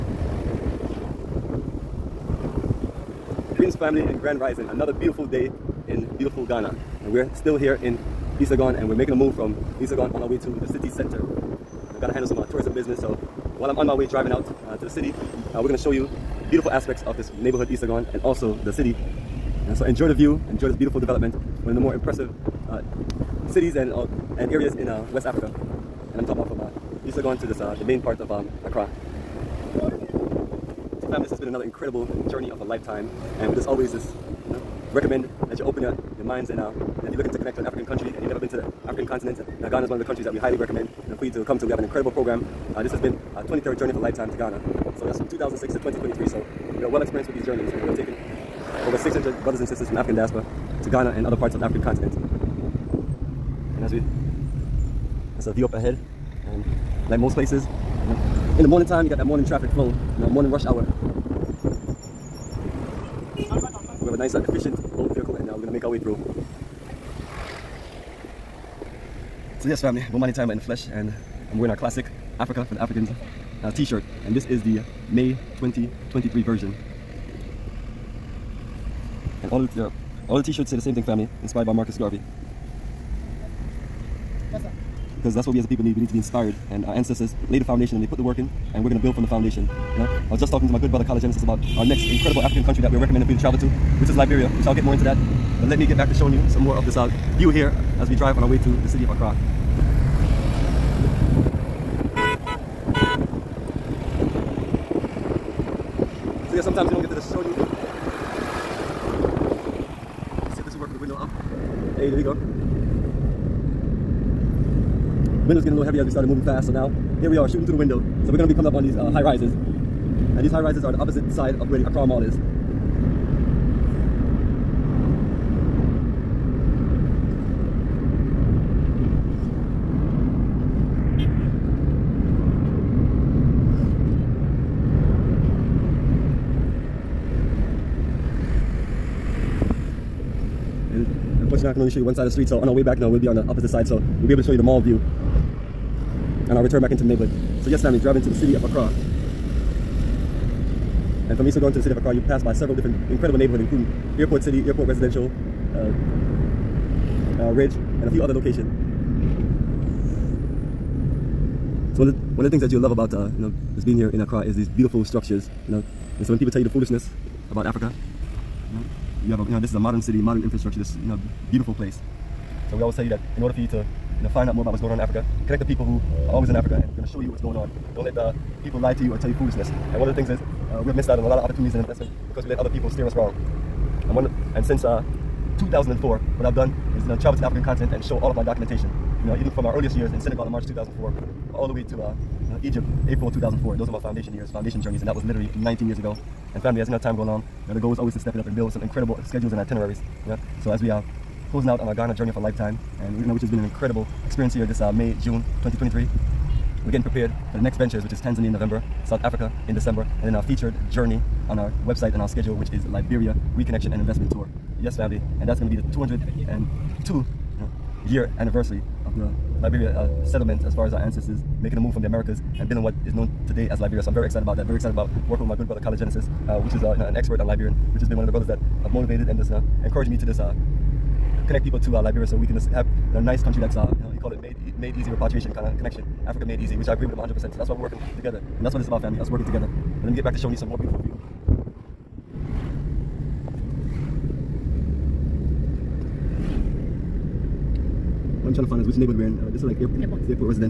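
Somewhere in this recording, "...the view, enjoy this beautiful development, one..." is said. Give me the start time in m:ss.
0:20.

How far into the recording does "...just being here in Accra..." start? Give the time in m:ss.
2:43.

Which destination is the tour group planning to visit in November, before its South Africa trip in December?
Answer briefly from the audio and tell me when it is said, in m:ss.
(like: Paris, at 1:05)
Tanzania, at 3:28.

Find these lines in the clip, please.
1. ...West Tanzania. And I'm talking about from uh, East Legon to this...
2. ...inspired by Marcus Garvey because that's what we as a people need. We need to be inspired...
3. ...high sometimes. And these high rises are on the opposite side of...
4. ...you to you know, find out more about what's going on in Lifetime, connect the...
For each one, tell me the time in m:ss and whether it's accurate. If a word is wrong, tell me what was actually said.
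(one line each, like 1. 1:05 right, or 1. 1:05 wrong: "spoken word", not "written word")
1. 0:25 wrong: "Africa", not "Tanzania"
2. 1:21 right
3. 1:59 wrong: "rises", not "sometimes"
4. 2:53 wrong: "Africa", not "Lifetime".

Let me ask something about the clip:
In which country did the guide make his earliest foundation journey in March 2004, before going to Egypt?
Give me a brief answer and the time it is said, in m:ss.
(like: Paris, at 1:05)
Senegal, at 3:10.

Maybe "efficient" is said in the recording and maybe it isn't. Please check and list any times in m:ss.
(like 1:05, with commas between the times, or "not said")
1:04.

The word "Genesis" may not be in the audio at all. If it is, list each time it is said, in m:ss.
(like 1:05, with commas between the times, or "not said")
1:31, 3:45.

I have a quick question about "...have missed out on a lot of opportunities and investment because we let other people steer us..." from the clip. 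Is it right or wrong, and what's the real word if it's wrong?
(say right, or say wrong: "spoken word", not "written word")
right.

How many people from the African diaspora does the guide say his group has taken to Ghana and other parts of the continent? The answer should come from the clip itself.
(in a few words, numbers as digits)
over 600.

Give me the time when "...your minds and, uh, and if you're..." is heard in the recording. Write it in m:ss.
0:36.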